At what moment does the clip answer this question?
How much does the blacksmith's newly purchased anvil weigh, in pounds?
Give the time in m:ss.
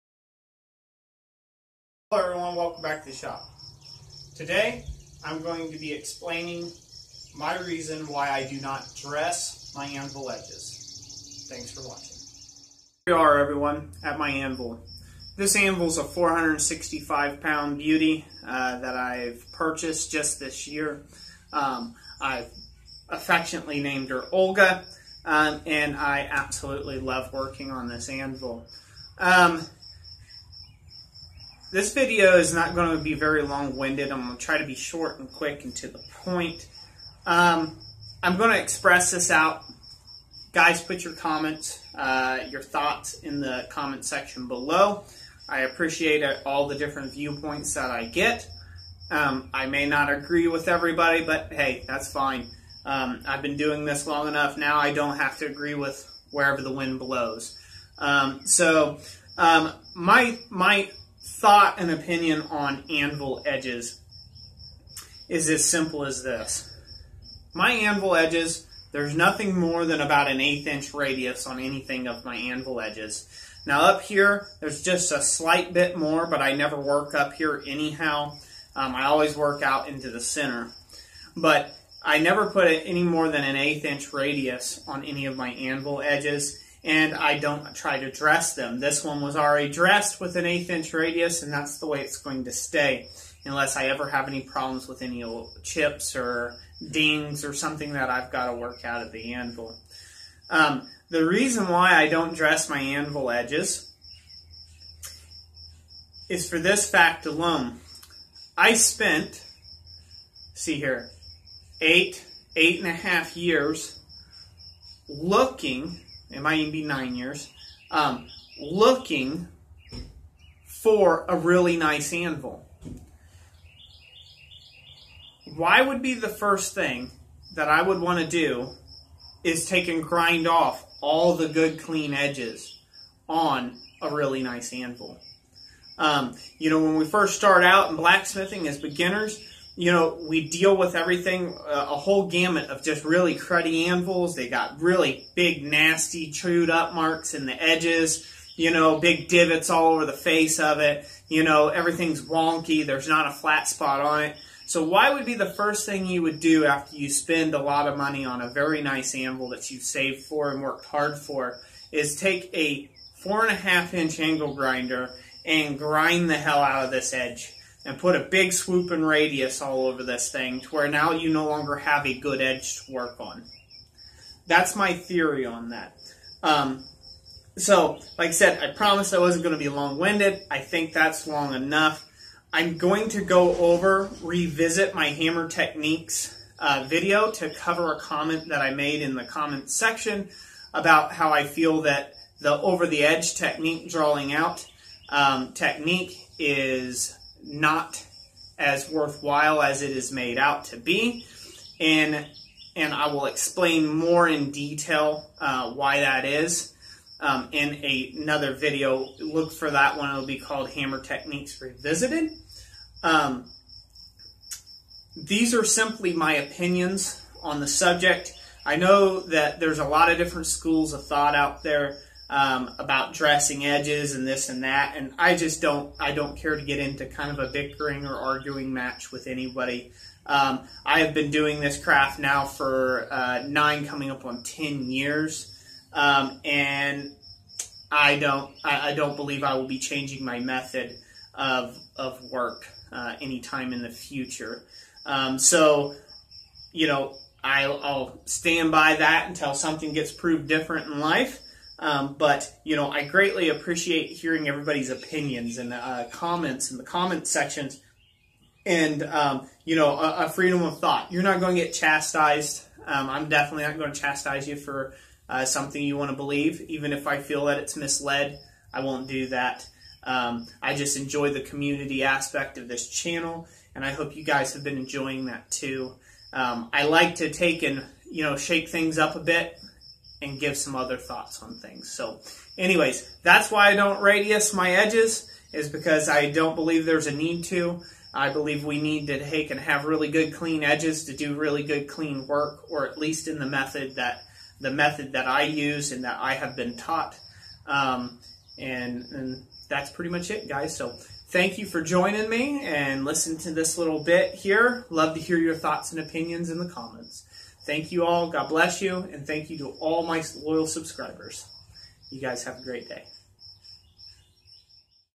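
0:16.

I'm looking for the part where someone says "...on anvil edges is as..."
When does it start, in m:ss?
1:02.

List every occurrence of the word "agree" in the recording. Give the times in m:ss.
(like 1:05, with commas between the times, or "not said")
0:50, 0:55.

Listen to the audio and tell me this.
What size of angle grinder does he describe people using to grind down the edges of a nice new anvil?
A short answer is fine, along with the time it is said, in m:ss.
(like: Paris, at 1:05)
4.5 inch, at 2:43.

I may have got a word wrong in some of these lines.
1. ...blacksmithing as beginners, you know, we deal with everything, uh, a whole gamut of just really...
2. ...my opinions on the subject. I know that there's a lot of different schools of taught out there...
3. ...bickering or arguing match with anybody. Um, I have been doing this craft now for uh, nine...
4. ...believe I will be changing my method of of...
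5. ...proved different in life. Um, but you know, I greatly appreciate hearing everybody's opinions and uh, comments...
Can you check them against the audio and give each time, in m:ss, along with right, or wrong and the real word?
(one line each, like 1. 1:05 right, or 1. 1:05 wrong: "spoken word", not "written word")
1. 2:17 right
2. 3:36 wrong: "thought", not "taught"
3. 3:47 right
4. 3:59 right
5. 4:10 right.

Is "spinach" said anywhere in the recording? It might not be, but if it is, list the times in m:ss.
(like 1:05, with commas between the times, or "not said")
not said.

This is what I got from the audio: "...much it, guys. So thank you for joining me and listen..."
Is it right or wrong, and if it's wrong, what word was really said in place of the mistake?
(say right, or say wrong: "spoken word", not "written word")
right.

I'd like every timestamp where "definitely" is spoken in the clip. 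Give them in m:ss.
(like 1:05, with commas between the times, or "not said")
4:23.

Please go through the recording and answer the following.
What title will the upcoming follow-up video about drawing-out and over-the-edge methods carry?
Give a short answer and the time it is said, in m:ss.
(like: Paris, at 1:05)
Hammer Techniques Revisited, at 3:30.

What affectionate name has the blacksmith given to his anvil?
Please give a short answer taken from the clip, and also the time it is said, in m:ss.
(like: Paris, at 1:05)
Olga, at 0:24.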